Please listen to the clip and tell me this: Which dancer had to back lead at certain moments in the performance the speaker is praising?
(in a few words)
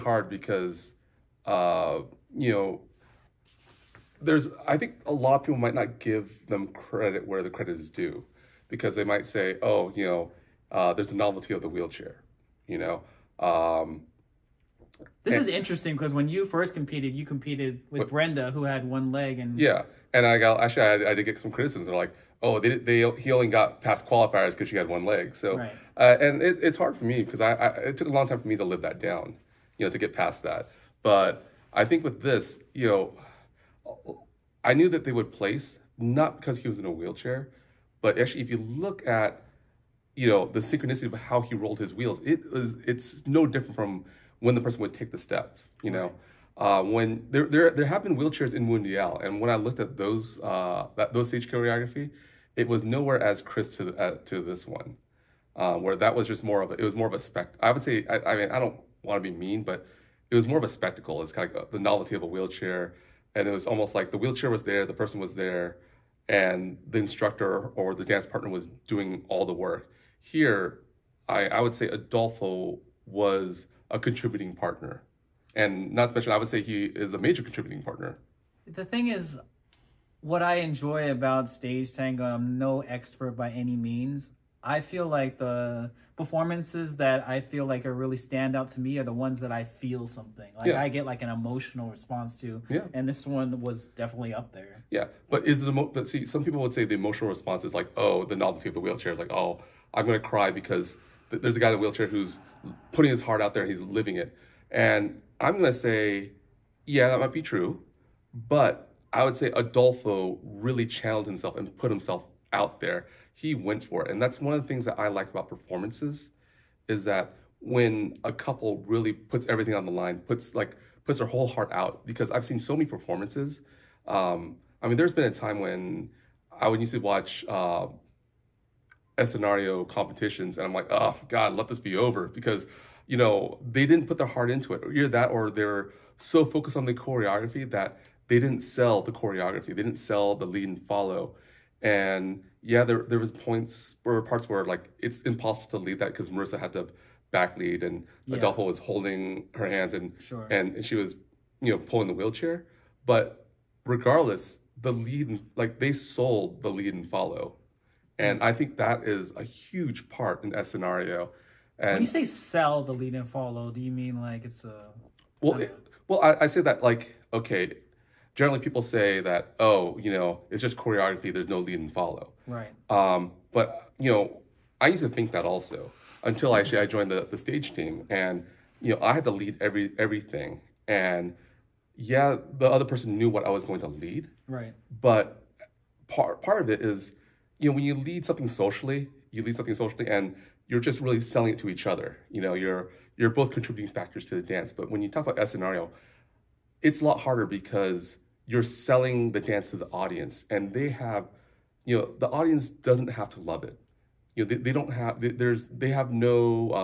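Marissa.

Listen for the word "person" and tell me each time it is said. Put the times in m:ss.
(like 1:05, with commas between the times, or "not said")
0:44, 1:04, 3:02.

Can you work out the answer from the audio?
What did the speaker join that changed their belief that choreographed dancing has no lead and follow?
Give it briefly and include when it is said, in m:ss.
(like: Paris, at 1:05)
the stage team, at 2:57.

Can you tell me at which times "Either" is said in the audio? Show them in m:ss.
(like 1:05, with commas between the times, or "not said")
2:14.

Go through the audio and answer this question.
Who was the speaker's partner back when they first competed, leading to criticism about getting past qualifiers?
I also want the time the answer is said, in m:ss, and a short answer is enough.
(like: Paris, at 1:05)
Brenda, at 0:18.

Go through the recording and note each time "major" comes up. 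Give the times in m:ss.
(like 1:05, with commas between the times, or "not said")
1:17.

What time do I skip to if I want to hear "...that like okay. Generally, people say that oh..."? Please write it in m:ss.
2:46.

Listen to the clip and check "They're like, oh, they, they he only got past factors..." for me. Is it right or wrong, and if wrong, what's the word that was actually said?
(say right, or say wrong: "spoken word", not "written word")
wrong: "qualifiers", not "factors".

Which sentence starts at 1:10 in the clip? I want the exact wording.
Here, I, I would say Adelfo was a contributing partner.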